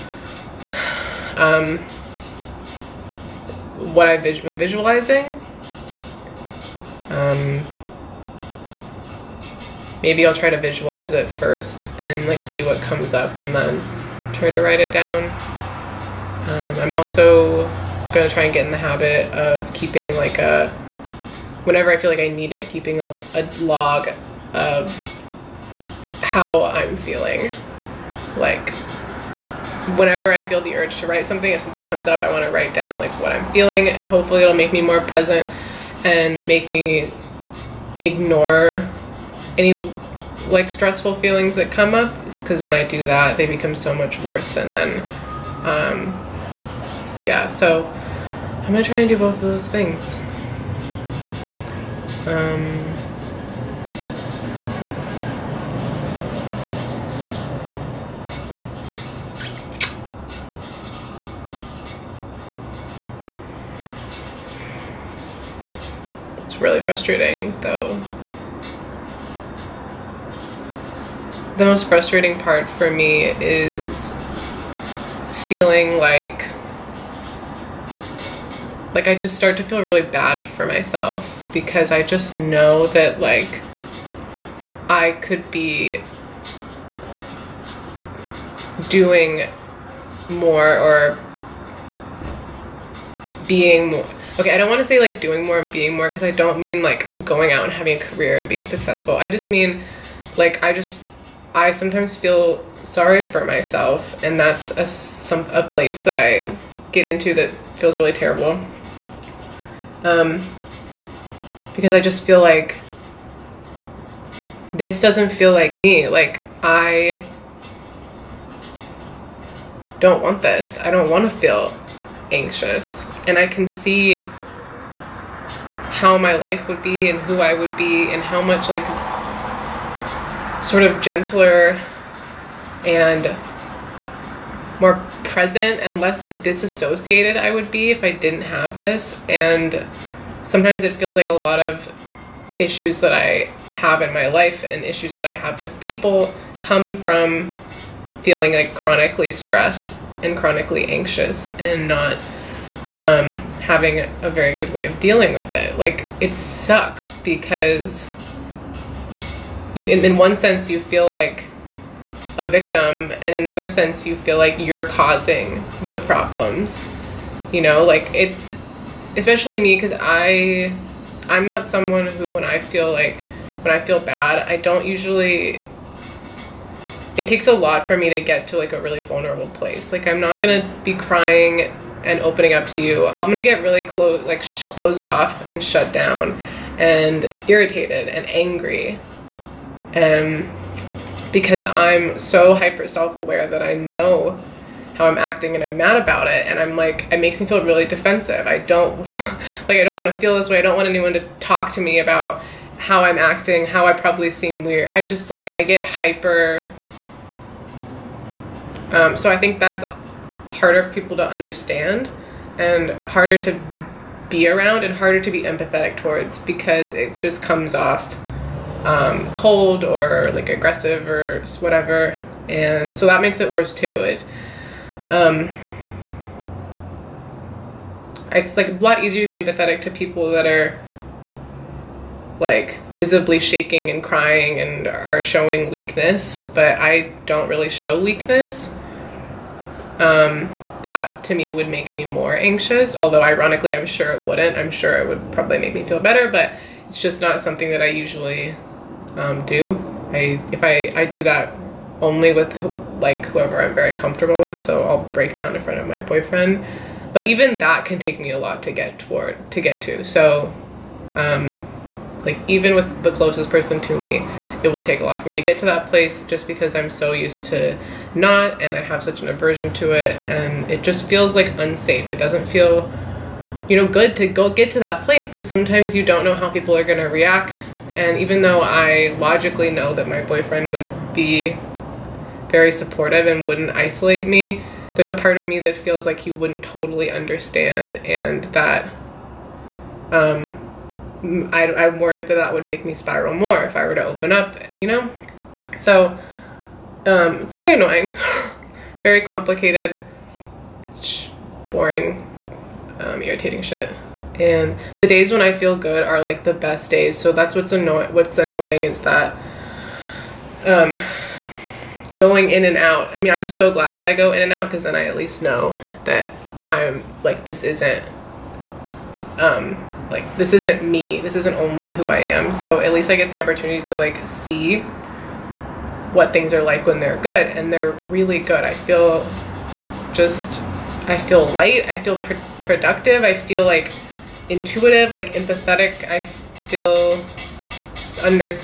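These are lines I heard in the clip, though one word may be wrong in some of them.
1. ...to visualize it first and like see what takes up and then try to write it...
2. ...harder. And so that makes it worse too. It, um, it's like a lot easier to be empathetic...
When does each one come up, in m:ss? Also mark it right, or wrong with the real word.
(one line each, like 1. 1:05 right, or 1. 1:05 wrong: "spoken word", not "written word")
1. 0:10 wrong: "comes", not "takes"
2. 3:41 wrong: "whatever", not "harder".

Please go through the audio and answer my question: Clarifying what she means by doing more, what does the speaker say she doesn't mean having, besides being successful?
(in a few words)
a career.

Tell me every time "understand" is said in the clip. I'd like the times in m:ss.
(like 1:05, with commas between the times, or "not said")
3:31, 4:47.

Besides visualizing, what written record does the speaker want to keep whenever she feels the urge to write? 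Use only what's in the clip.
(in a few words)
log.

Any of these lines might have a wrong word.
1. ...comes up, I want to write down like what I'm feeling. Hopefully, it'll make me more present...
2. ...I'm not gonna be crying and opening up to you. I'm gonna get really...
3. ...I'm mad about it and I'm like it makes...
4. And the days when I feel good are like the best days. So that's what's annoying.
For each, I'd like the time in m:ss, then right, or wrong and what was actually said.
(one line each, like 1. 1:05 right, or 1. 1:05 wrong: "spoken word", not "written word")
1. 0:31 right
2. 3:00 right
3. 3:15 right
4. 5:04 right.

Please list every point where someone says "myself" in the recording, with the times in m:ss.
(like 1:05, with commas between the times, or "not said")
1:20, 1:43.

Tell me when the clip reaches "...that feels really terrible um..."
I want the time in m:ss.
1:47.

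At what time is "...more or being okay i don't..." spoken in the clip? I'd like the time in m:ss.
1:30.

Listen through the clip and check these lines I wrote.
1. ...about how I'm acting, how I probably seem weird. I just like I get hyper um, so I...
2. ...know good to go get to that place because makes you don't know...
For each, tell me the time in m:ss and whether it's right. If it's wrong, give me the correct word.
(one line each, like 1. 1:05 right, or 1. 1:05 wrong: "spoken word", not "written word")
1. 3:21 right
2. 4:33 wrong: "sometimes", not "makes".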